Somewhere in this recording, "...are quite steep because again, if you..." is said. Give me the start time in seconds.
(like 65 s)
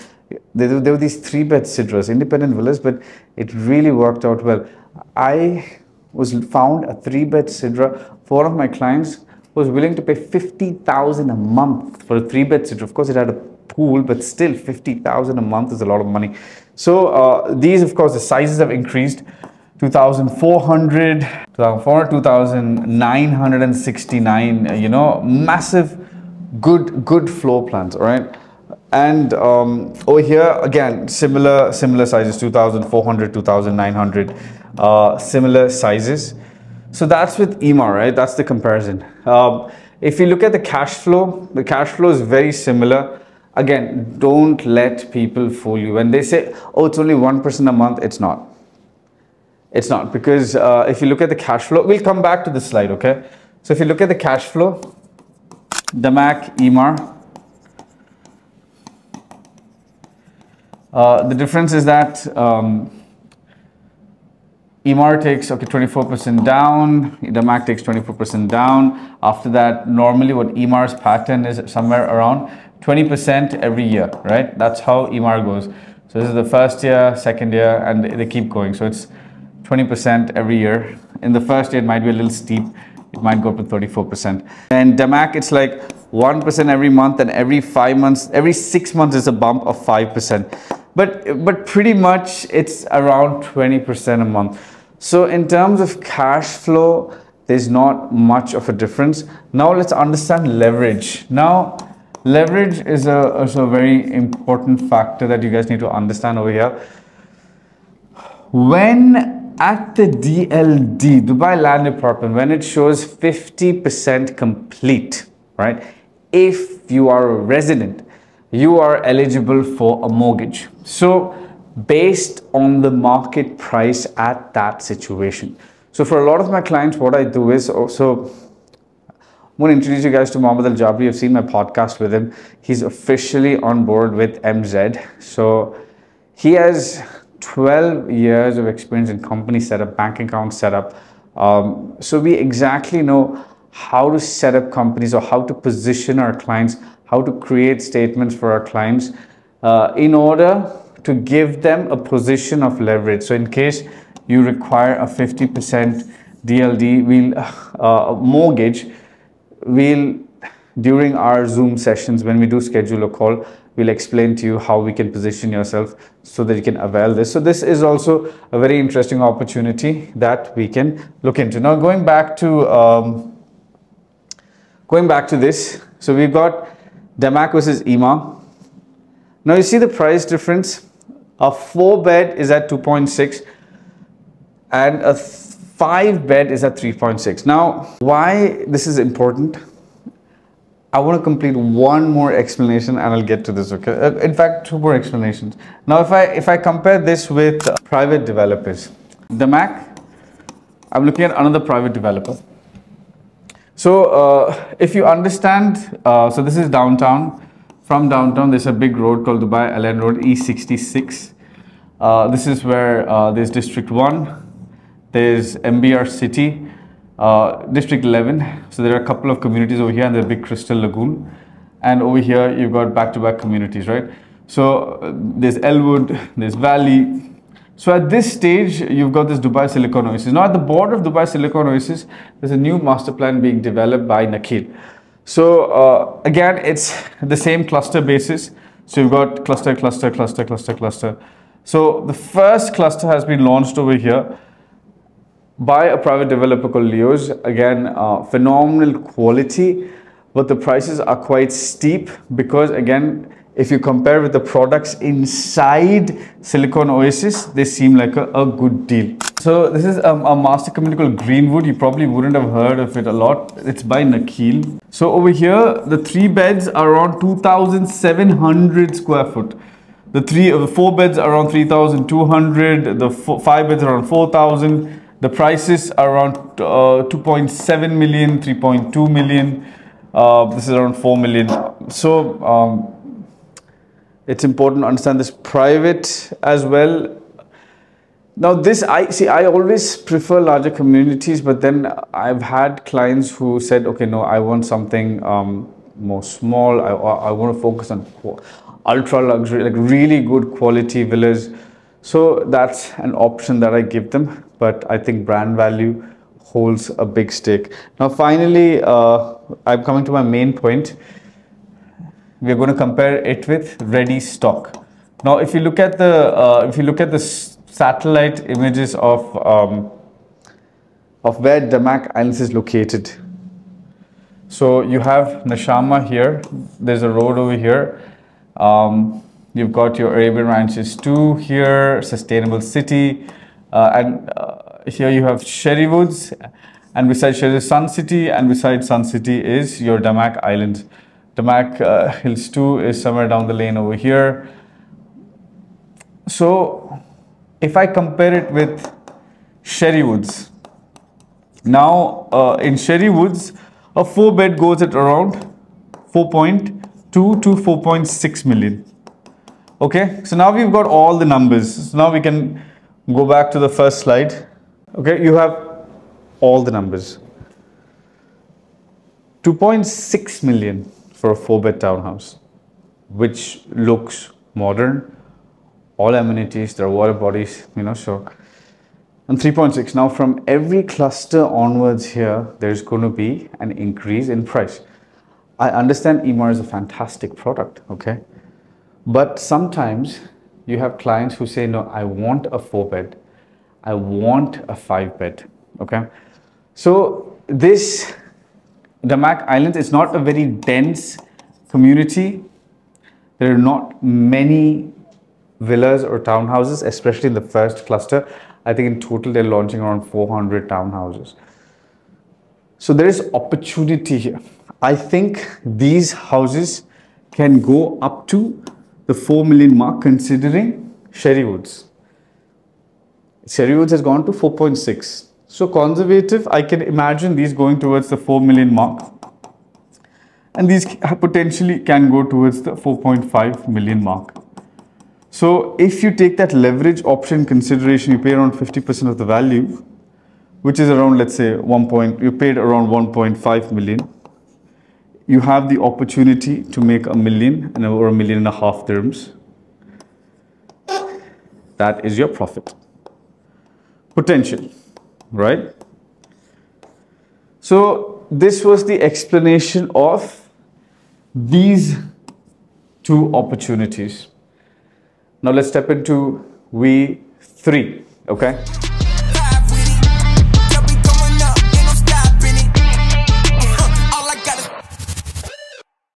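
250 s.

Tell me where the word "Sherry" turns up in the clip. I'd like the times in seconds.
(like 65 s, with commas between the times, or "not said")
337 s, 423 s.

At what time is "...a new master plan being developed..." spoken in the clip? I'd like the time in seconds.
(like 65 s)
232 s.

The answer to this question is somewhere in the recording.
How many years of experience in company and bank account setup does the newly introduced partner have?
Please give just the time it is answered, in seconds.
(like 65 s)
137 s.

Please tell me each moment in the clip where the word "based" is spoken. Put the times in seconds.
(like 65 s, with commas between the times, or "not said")
121 s.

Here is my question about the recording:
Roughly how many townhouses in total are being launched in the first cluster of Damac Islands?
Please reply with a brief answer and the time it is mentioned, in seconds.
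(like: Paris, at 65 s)
400, at 410 s.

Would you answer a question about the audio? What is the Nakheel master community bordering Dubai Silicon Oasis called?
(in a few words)
Greenwood.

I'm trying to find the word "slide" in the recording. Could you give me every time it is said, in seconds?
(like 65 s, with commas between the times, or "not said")
52 s, 363 s.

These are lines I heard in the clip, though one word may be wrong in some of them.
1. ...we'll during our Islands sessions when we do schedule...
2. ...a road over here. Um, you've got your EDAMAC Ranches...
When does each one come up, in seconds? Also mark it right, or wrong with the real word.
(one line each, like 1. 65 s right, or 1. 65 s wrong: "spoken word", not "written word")
1. 159 s wrong: "Zoom", not "Islands"
2. 327 s wrong: "Arabian", not "EDAMAC".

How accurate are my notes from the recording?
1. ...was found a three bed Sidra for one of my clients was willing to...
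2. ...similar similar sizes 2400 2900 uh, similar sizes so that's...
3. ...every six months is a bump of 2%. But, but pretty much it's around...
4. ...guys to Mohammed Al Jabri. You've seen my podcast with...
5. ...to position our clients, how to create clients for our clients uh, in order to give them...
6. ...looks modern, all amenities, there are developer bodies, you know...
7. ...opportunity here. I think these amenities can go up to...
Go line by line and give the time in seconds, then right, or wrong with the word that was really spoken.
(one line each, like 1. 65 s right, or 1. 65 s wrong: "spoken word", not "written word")
1. 6 s right
2. 31 s right
3. 88 s wrong: "5", not "2"
4. 130 s right
5. 145 s wrong: "statements", not "clients"
6. 373 s wrong: "water", not "developer"
7. 413 s wrong: "houses", not "amenities".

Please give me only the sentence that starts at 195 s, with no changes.
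Now, if I, if I compare this with private developers, DAMAC, I'm looking at another private developer.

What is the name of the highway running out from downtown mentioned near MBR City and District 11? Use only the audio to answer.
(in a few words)
Dubai Al Ain Road.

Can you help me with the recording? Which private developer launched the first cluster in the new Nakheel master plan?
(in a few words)
Leo's.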